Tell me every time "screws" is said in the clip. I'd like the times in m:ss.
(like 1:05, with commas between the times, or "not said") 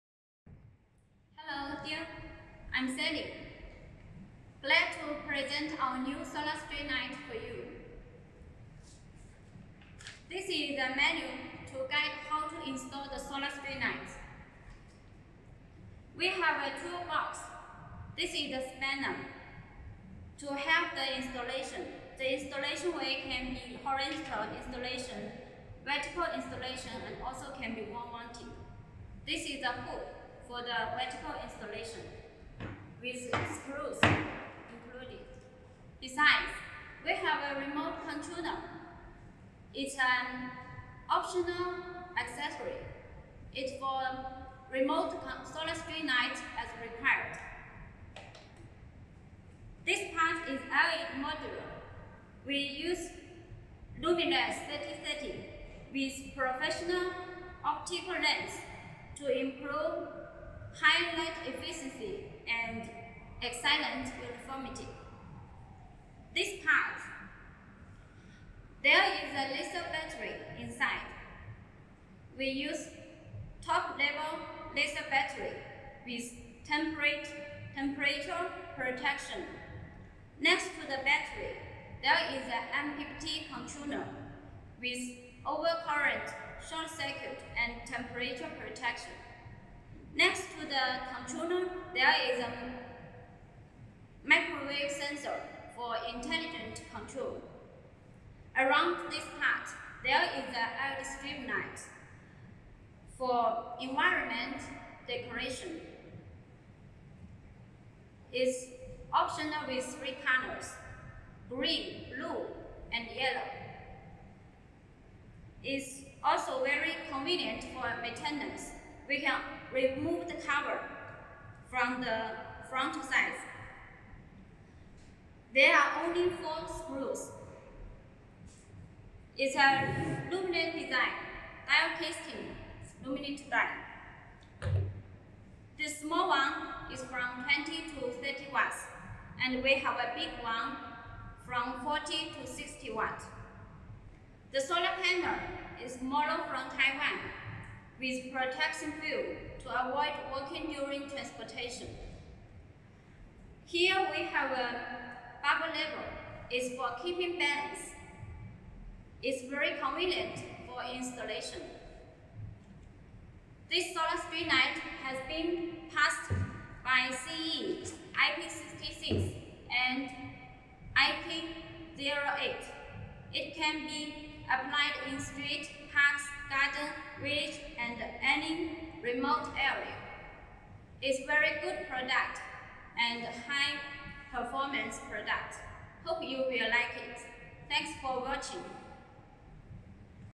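0:33, 2:06.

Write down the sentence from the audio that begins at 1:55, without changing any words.
It's also very convenient for maintenance we can remove the cover from the front sides.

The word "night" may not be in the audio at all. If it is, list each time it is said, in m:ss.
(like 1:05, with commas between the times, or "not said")
0:06, 0:13.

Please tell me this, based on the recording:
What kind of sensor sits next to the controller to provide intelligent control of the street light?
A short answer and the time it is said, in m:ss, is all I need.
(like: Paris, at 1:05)
Microwave sensor, at 1:34.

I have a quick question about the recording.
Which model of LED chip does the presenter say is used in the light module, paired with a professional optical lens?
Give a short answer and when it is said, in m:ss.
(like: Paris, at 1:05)
Luminous 3030, at 0:53.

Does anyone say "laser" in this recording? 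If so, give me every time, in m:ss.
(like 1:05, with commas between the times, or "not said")
1:09, 1:14.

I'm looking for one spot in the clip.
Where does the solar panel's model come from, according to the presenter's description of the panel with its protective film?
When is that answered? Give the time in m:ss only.
2:26.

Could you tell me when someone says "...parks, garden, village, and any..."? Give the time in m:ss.
2:55.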